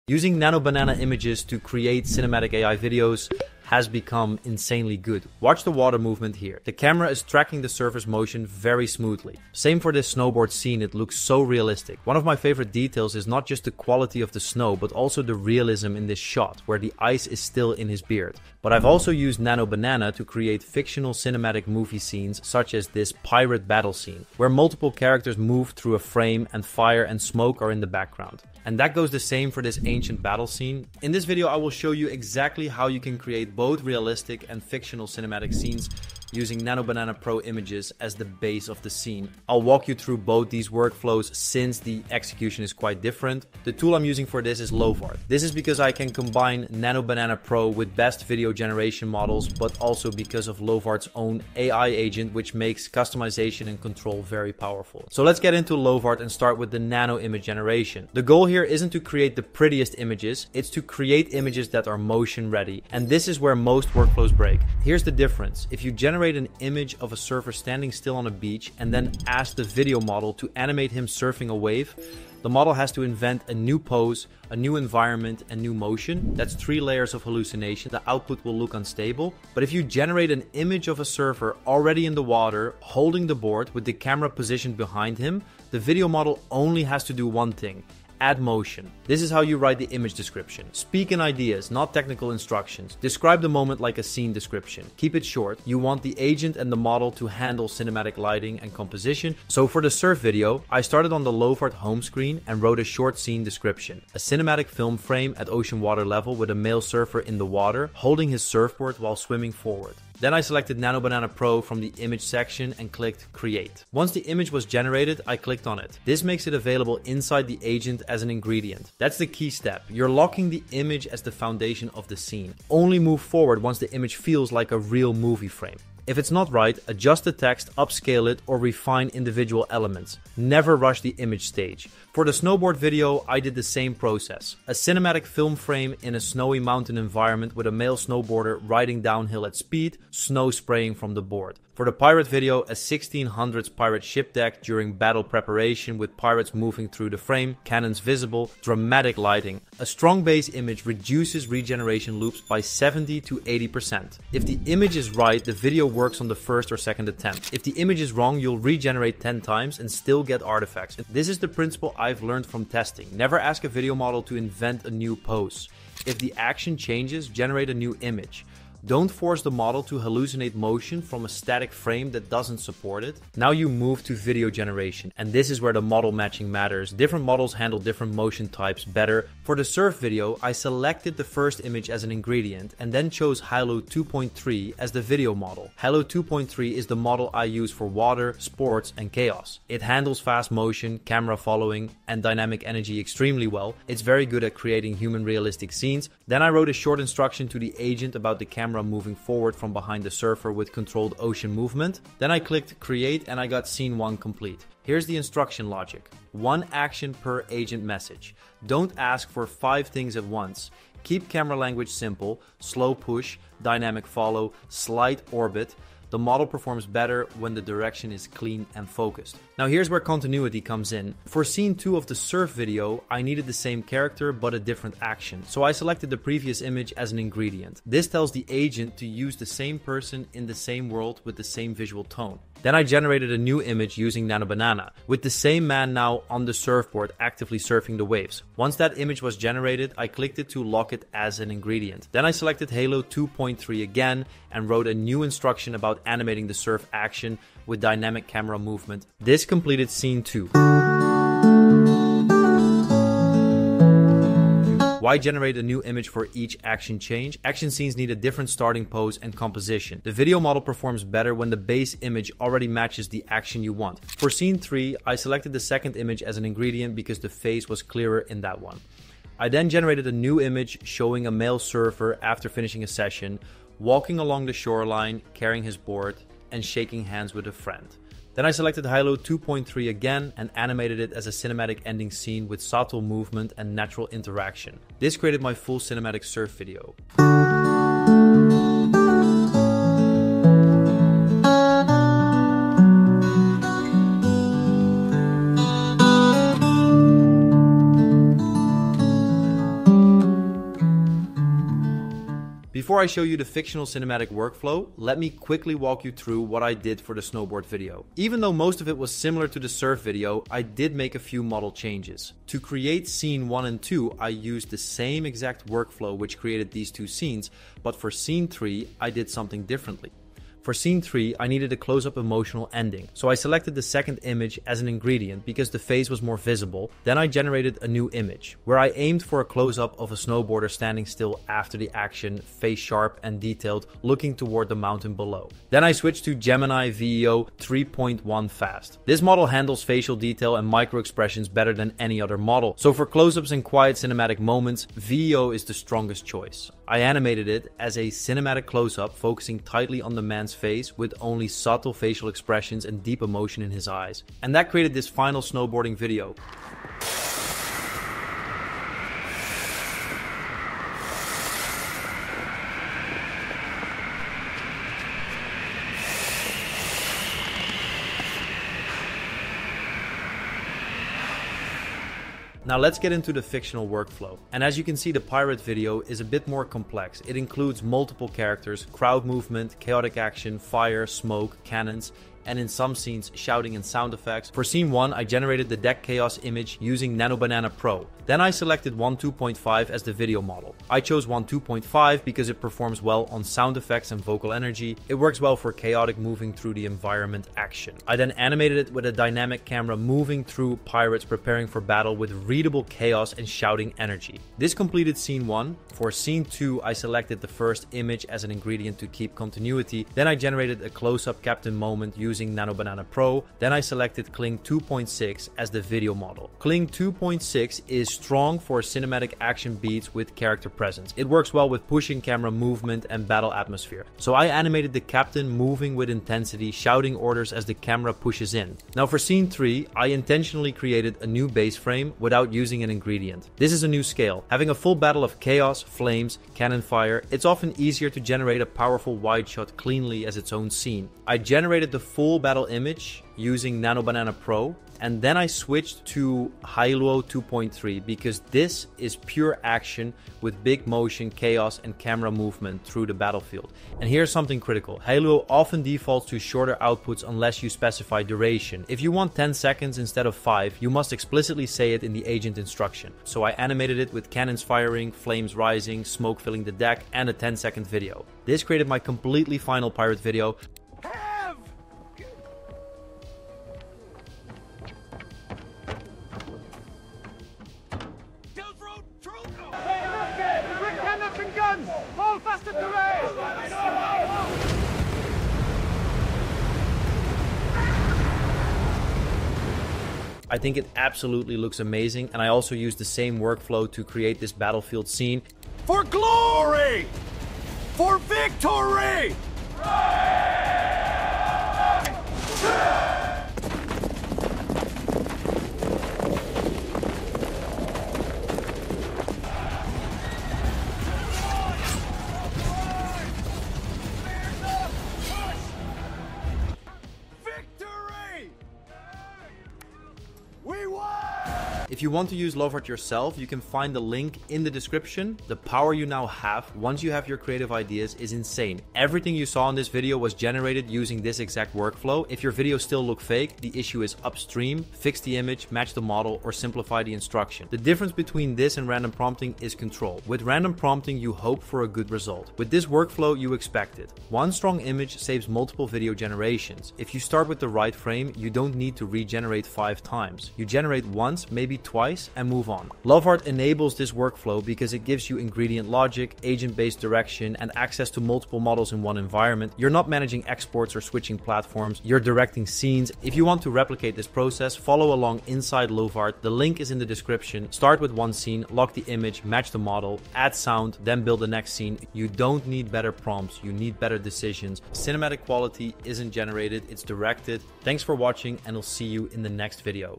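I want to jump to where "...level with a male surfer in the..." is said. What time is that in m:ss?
1:46.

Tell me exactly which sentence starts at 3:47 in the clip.
This tells the agent to use the same person in the same world with the same visual tone.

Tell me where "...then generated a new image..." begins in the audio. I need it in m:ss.
4:29.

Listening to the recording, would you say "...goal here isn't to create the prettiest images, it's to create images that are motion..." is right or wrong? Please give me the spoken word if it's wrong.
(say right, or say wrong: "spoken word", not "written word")
right.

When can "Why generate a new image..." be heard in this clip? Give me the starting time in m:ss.
4:15.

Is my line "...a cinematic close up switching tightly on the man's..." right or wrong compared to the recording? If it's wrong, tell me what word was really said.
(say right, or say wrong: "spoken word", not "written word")
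wrong: "focusing", not "switching".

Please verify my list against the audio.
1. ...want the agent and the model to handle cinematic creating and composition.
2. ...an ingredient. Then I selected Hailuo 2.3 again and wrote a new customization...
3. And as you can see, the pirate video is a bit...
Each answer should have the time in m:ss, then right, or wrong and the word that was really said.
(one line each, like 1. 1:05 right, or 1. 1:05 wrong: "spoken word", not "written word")
1. 1:35 wrong: "lighting", not "creating"
2. 4:01 wrong: "instruction", not "customization"
3. 6:14 right.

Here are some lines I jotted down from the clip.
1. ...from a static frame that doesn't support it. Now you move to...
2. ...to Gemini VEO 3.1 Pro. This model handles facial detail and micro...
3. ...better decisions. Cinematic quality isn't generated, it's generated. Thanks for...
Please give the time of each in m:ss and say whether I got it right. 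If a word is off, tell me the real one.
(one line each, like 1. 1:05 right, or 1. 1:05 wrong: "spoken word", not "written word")
1. 2:51 right
2. 5:36 wrong: "Fast", not "Pro"
3. 9:33 wrong: "directed", not "generated".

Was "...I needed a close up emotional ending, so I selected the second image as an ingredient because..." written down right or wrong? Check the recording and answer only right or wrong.
right.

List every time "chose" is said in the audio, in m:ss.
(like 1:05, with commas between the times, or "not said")
3:03, 6:31.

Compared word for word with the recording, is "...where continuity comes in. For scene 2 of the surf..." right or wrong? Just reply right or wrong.
right.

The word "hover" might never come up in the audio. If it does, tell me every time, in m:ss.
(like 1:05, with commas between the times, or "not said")
not said.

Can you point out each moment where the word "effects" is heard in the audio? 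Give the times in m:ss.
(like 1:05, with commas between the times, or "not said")
6:24, 6:33.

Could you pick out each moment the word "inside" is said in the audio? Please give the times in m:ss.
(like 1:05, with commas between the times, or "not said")
1:57, 9:25.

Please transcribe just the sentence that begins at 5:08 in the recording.
Even though most of it was similar to the surf video, I did make a few model changes.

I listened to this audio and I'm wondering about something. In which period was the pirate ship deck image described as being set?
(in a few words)
1600s.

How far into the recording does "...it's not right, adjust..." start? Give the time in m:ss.
2:06.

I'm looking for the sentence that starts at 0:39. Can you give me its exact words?
I'll walk you through both these workflows since the execution is quite different.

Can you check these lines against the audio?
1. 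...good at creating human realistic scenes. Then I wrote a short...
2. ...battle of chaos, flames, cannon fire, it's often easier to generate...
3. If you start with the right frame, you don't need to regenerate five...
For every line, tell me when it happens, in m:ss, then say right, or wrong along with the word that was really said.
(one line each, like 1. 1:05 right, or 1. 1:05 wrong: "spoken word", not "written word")
1. 3:14 right
2. 7:14 right
3. 9:06 right.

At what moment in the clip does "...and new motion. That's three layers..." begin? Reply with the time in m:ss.
1:15.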